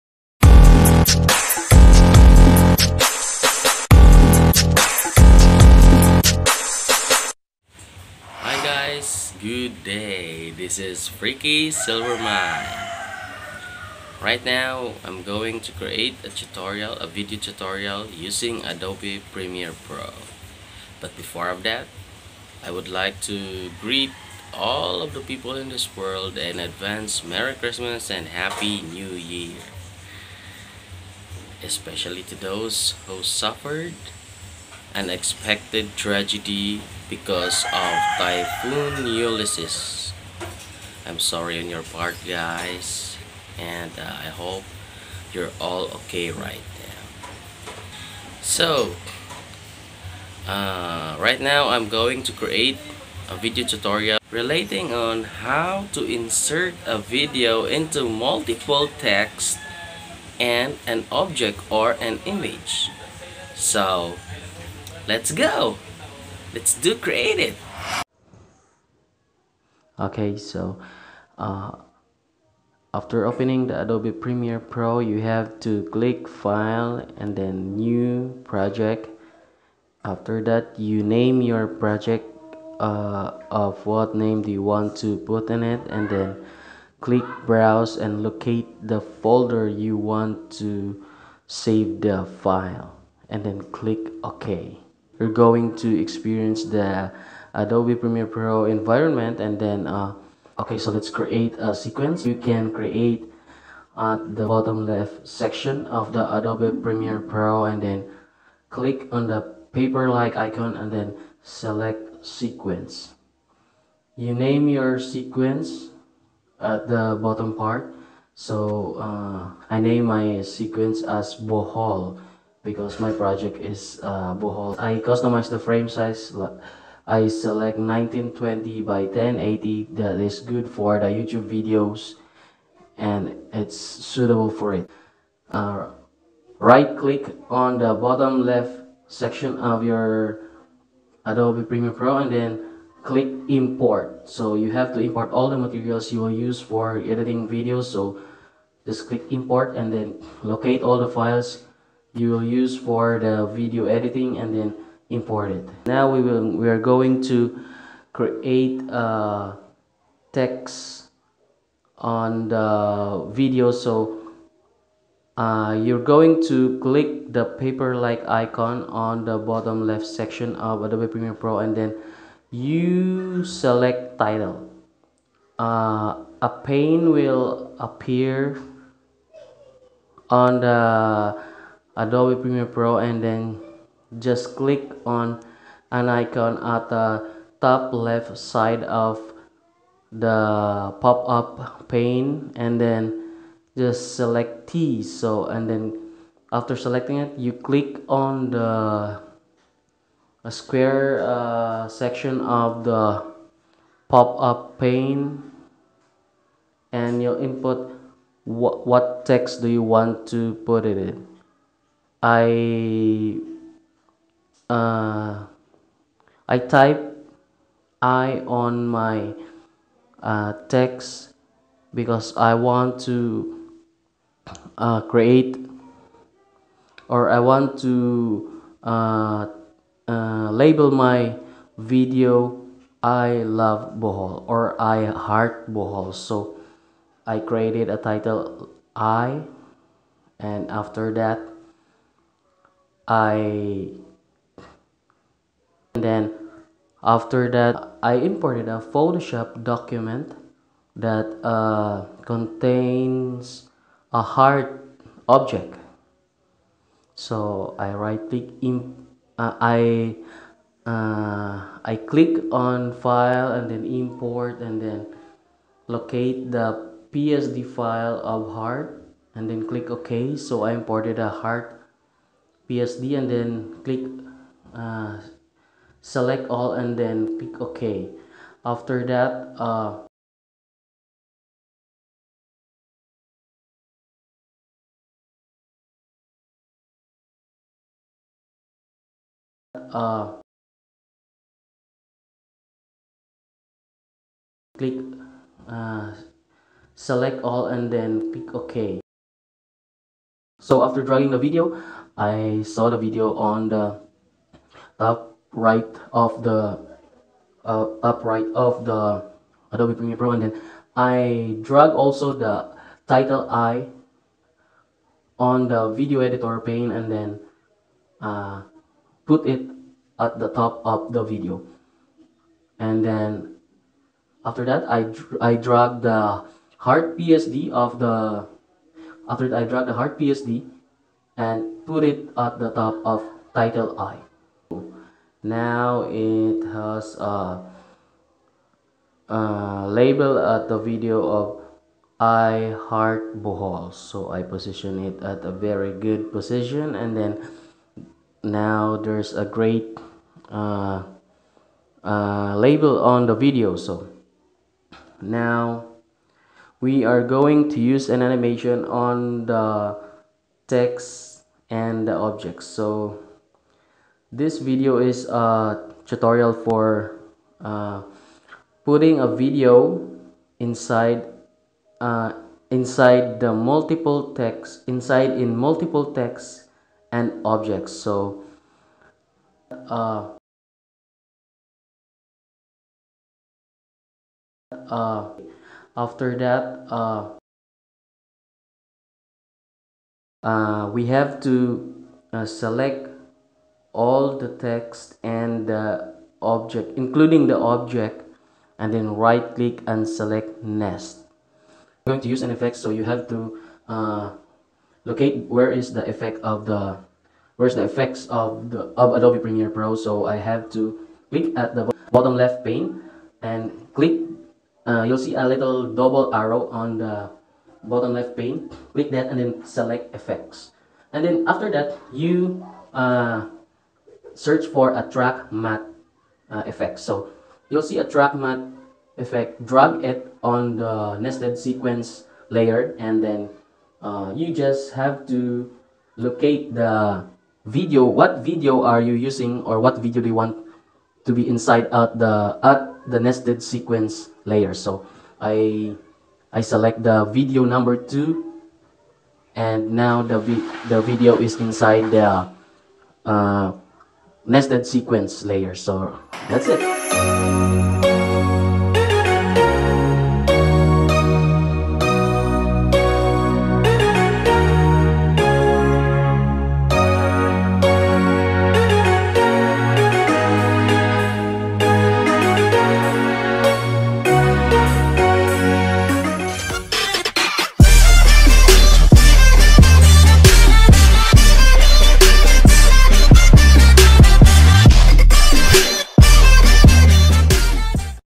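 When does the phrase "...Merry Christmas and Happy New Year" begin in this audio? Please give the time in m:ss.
0:27.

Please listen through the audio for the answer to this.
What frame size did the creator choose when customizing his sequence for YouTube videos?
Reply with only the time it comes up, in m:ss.
2:07.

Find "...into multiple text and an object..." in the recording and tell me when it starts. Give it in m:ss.
0:57.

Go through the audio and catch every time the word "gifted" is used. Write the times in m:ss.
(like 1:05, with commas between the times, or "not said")
not said.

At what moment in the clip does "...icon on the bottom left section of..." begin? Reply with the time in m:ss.
2:48.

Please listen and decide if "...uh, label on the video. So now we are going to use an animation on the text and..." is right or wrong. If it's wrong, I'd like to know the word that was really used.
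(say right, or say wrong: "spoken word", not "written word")
right.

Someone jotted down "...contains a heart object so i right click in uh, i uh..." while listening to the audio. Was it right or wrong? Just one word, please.
right.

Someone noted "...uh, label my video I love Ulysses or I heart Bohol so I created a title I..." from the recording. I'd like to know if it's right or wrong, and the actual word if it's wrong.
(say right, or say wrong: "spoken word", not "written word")
wrong: "Bohol", not "Ulysses".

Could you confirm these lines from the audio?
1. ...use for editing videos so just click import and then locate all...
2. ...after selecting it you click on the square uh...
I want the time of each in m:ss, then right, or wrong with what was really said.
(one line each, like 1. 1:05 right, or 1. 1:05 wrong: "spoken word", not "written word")
1. 2:26 right
2. 3:16 right.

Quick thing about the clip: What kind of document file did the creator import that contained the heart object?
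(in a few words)
Photoshop document.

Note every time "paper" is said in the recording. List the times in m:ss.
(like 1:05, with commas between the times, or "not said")
1:49, 2:47.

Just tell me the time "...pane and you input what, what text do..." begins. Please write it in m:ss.
3:24.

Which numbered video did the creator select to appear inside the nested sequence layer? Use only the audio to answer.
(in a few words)
2.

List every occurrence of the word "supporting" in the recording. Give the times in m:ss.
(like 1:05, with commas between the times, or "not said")
not said.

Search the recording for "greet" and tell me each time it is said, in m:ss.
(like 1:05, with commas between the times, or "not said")
0:23.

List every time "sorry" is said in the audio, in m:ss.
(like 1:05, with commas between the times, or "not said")
0:41.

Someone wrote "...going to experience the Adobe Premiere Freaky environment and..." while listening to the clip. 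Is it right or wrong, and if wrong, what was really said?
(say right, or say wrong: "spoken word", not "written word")
wrong: "Pro", not "Freaky".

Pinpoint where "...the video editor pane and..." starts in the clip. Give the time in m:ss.
5:15.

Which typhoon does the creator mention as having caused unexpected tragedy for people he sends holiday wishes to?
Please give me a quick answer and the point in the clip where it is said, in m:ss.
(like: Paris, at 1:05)
Typhoon Ulysses, at 0:38.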